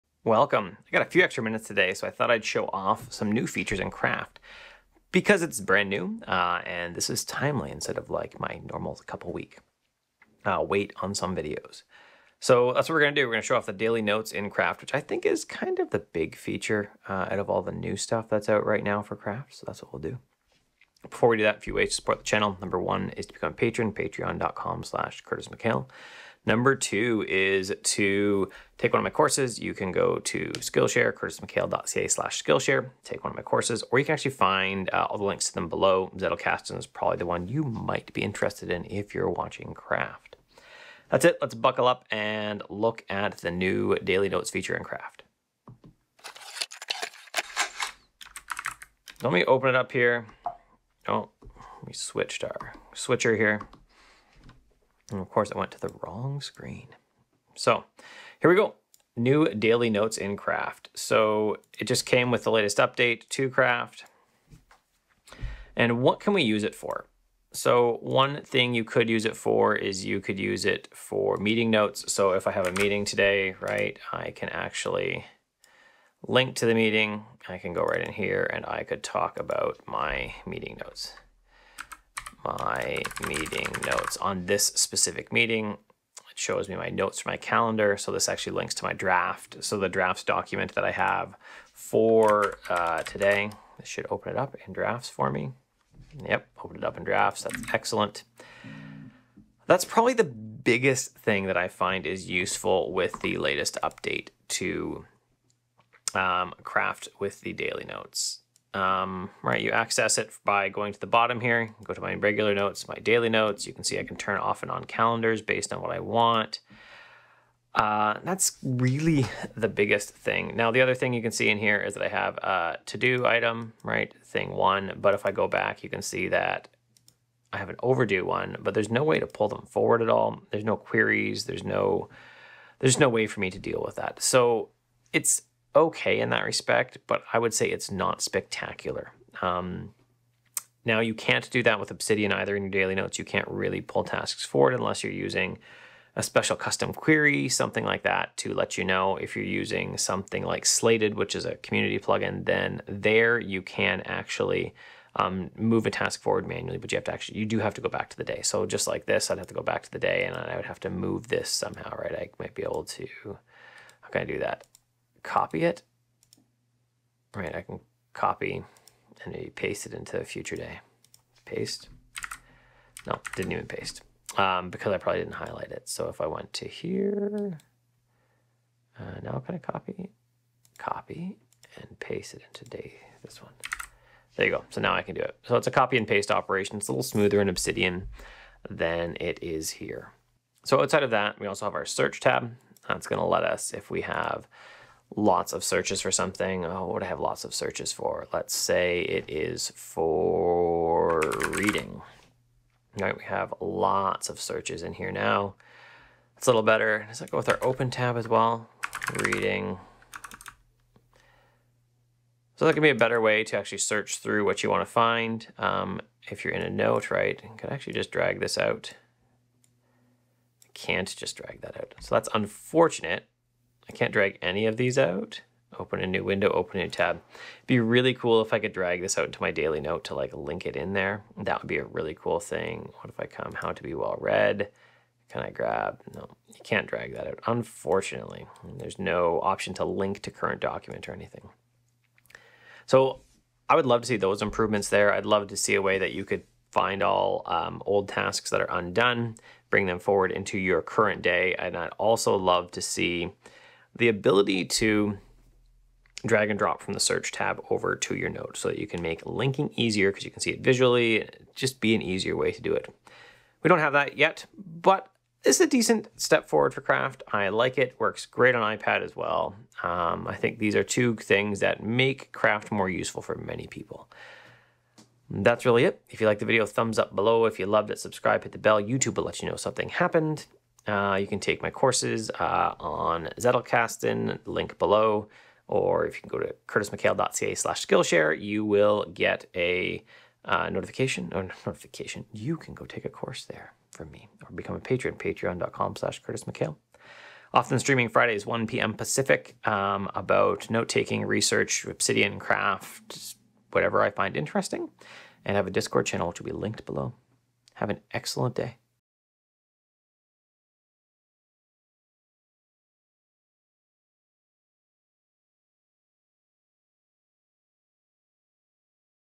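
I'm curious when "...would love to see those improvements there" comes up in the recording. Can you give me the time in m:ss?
4:03.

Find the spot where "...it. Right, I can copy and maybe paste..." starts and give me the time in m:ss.
2:45.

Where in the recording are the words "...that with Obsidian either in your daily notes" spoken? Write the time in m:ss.
2:21.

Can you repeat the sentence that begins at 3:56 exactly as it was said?
No, you can't drag that out, unfortunately.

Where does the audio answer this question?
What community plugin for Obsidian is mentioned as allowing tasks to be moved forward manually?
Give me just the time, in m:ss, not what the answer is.
2:30.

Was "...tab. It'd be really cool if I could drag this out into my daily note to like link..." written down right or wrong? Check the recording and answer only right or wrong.
right.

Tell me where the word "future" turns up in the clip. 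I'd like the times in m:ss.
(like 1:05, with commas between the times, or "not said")
2:50.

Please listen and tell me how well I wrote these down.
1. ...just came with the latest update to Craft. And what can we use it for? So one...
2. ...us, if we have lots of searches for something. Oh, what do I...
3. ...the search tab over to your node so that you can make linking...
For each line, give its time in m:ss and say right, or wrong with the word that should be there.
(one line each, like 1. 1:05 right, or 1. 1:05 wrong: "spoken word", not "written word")
1. 1:01 right
2. 3:13 right
3. 4:16 right.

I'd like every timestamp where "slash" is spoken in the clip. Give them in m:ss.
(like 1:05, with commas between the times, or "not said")
0:24, 0:32, 4:47, 4:55.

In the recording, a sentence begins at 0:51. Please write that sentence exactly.
Oh, we switched our switcher here.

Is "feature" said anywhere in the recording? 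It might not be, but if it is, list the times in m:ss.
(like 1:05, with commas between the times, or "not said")
0:03, 0:16, 0:44.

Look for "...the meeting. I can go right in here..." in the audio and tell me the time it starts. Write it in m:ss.
1:16.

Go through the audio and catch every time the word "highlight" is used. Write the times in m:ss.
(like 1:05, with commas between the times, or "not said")
2:55.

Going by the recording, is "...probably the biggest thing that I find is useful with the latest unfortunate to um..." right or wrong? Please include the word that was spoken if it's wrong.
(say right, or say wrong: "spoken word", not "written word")
wrong: "update", not "unfortunate".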